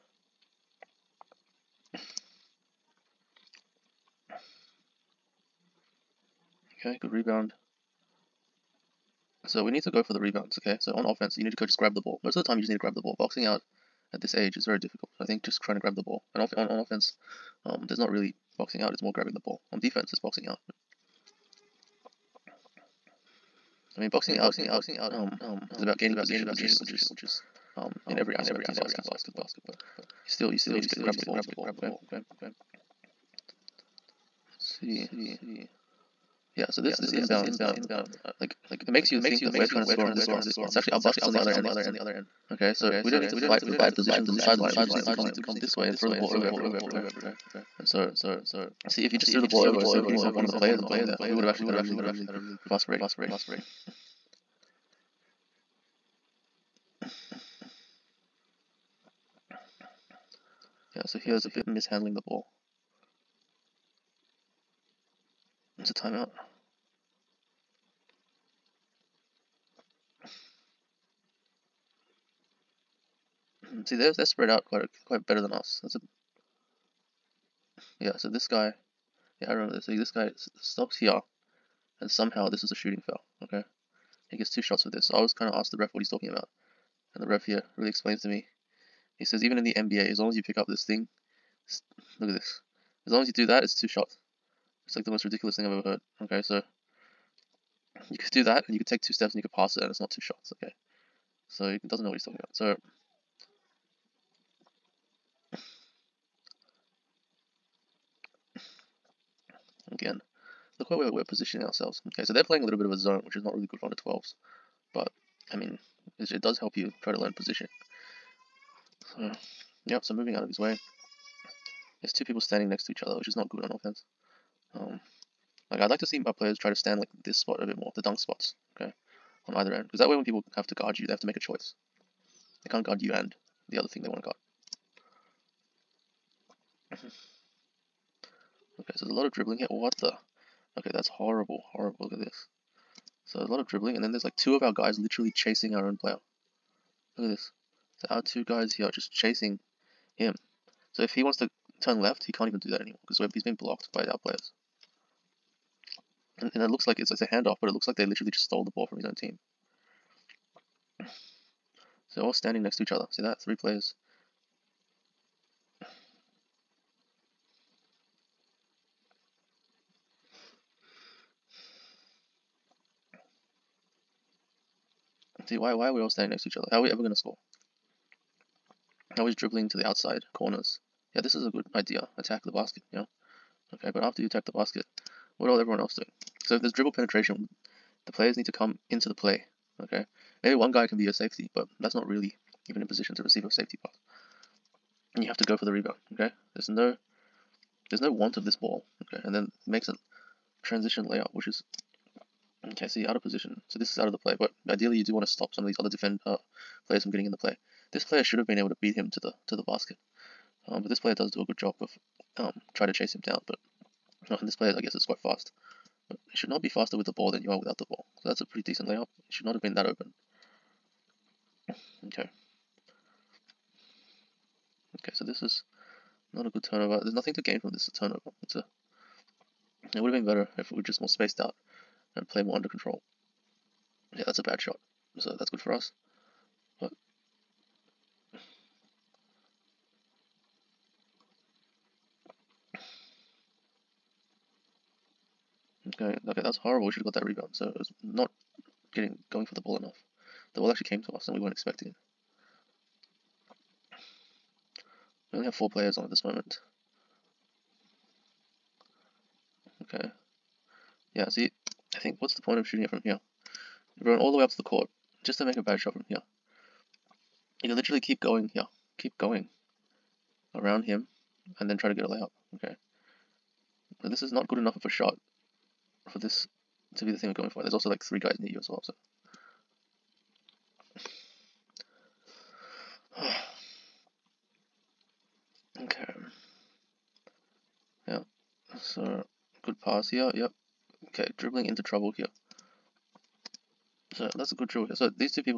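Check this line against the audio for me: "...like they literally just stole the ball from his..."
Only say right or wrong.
right.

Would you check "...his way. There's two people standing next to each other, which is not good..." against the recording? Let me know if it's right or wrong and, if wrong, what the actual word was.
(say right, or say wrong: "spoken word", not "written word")
right.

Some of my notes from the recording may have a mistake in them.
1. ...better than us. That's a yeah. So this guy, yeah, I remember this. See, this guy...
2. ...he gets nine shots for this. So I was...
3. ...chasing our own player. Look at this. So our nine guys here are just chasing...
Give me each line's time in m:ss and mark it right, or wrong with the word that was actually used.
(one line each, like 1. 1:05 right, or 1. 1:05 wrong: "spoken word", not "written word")
1. 1:15 right
2. 1:24 wrong: "two", not "nine"
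3. 2:25 wrong: "two", not "nine".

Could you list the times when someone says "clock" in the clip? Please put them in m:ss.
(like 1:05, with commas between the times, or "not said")
not said.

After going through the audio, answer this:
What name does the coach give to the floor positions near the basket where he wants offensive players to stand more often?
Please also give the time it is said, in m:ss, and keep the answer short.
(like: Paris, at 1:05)
Dunk spots, at 2:07.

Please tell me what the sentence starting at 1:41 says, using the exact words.
So it doesn't know what he's talking about.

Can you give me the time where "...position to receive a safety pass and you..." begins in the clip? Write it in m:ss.
3:12.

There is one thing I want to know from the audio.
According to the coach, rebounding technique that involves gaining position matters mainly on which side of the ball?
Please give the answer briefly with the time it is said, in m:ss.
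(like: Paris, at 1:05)
Defense, at 0:19.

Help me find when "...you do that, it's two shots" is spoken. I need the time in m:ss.
1:33.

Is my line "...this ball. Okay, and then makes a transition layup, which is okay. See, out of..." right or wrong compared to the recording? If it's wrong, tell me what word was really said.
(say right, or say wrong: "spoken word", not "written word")
right.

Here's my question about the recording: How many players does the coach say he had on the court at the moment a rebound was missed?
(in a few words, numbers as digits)
4.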